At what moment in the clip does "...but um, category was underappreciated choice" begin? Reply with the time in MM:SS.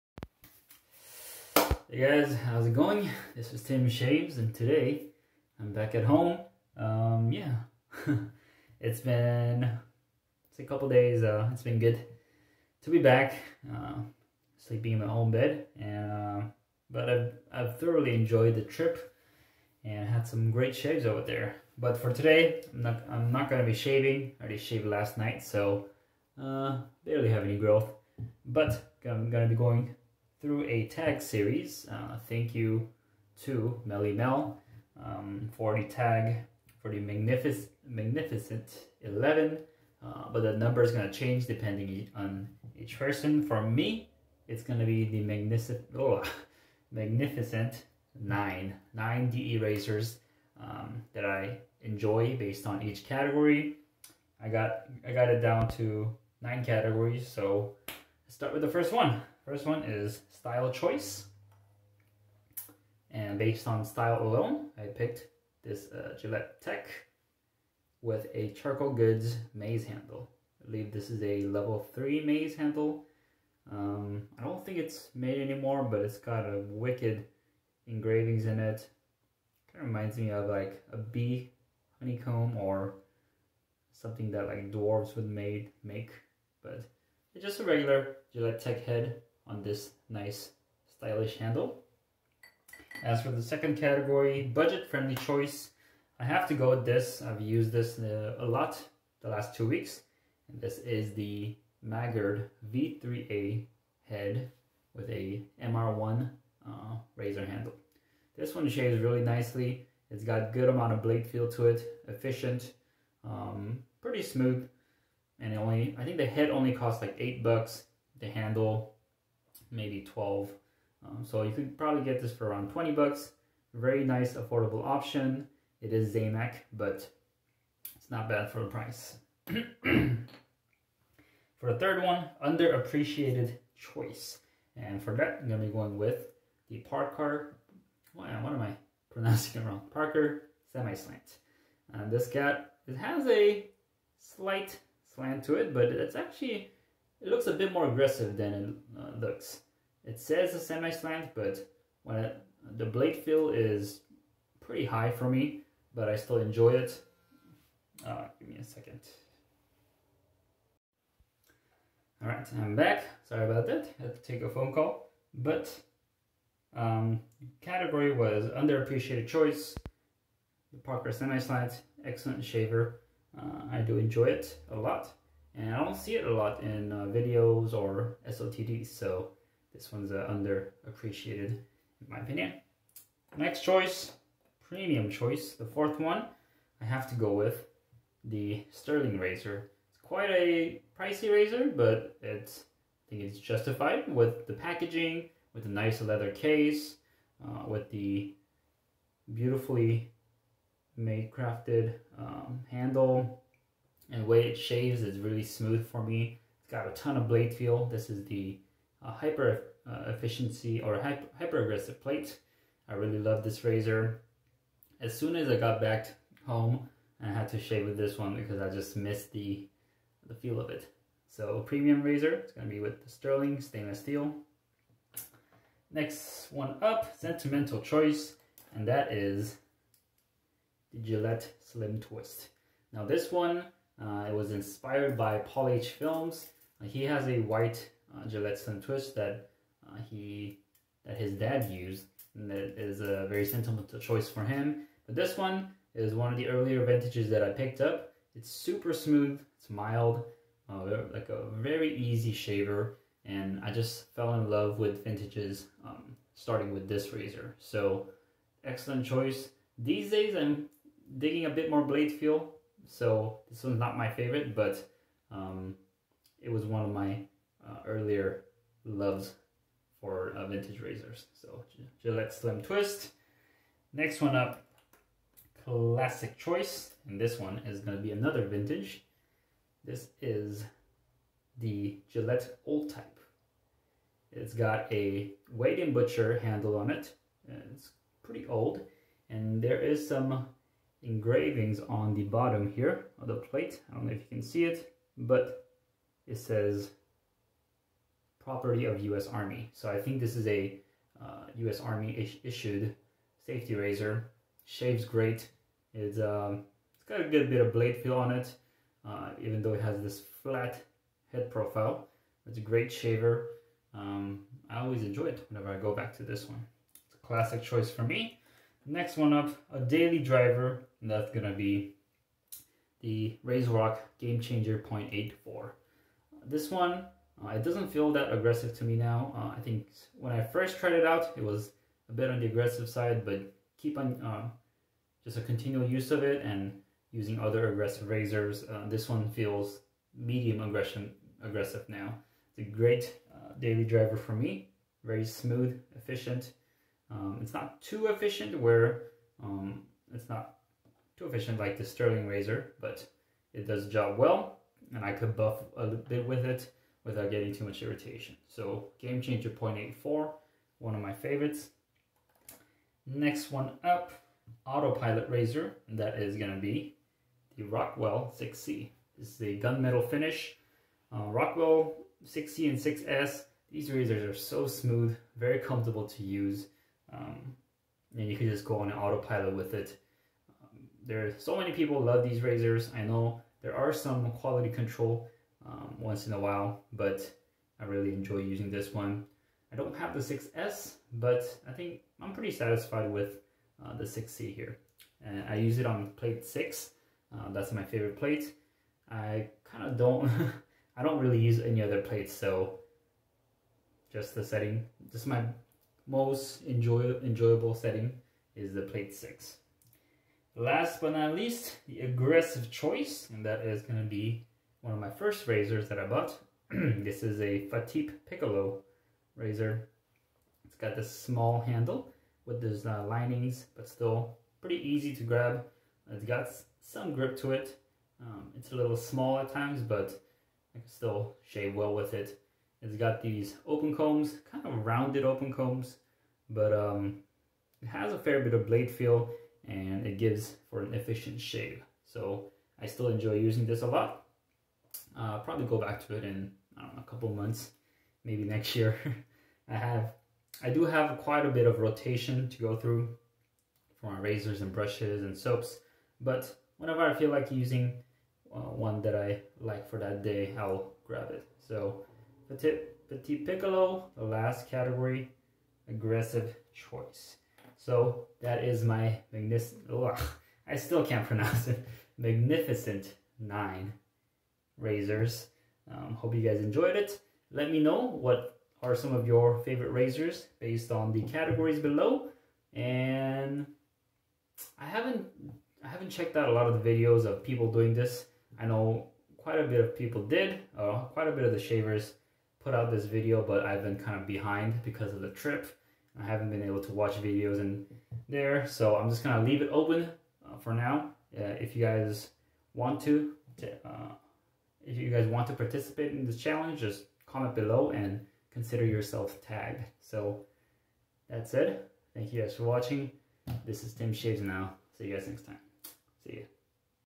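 02:45.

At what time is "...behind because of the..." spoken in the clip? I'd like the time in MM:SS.
08:14.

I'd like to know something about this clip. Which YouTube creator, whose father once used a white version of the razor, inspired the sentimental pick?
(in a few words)
Paul H. Films.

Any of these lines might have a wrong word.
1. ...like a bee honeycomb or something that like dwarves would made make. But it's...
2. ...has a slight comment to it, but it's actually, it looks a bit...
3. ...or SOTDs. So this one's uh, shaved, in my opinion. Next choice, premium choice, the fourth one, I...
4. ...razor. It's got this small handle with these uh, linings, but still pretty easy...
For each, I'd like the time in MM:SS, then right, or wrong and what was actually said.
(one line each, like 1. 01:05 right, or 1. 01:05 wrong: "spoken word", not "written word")
1. 01:20 right
2. 02:22 wrong: "slant", not "comment"
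3. 02:57 wrong: "underappreciated", not "shaved"
4. 06:59 right.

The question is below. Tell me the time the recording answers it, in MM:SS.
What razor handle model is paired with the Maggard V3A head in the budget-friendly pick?
01:45.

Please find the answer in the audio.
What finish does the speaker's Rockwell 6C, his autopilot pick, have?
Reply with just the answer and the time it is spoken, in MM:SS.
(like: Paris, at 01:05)
gunmetal, at 06:09.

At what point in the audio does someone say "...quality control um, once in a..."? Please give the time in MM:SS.
06:24.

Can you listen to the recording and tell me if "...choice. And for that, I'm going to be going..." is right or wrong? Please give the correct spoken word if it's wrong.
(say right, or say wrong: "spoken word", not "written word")
right.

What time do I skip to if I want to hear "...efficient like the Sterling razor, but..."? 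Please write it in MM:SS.
05:51.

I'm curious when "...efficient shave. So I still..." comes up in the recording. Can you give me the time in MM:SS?
07:20.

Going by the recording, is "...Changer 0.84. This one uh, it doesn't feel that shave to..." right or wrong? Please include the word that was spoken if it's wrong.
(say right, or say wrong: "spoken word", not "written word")
wrong: "aggressive", not "shave".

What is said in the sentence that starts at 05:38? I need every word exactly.
Uh, this one feels medium aggression aggressive now.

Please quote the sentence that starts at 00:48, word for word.
9 DE erasers um, that I enjoy based on each category.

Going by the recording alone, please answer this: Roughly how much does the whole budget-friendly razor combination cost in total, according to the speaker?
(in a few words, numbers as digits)
20 bucks.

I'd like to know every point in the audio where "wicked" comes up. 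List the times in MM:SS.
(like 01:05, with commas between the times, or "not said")
01:16.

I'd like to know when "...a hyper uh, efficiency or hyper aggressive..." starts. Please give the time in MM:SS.
03:29.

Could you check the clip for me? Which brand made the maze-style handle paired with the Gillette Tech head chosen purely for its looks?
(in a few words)
Charcoal Goods.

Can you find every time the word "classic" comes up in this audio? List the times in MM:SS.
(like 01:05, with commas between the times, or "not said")
04:35, 05:17.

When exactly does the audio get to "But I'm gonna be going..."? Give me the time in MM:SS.
00:28.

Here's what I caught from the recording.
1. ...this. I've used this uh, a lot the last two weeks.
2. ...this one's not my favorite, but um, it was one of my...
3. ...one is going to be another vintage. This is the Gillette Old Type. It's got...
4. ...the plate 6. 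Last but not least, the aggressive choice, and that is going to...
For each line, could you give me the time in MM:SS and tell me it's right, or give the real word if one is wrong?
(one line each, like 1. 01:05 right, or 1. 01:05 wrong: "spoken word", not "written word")
1. 01:36 right
2. 04:23 right
3. 04:37 right
4. 06:48 right.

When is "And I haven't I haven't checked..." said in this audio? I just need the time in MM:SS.
08:02.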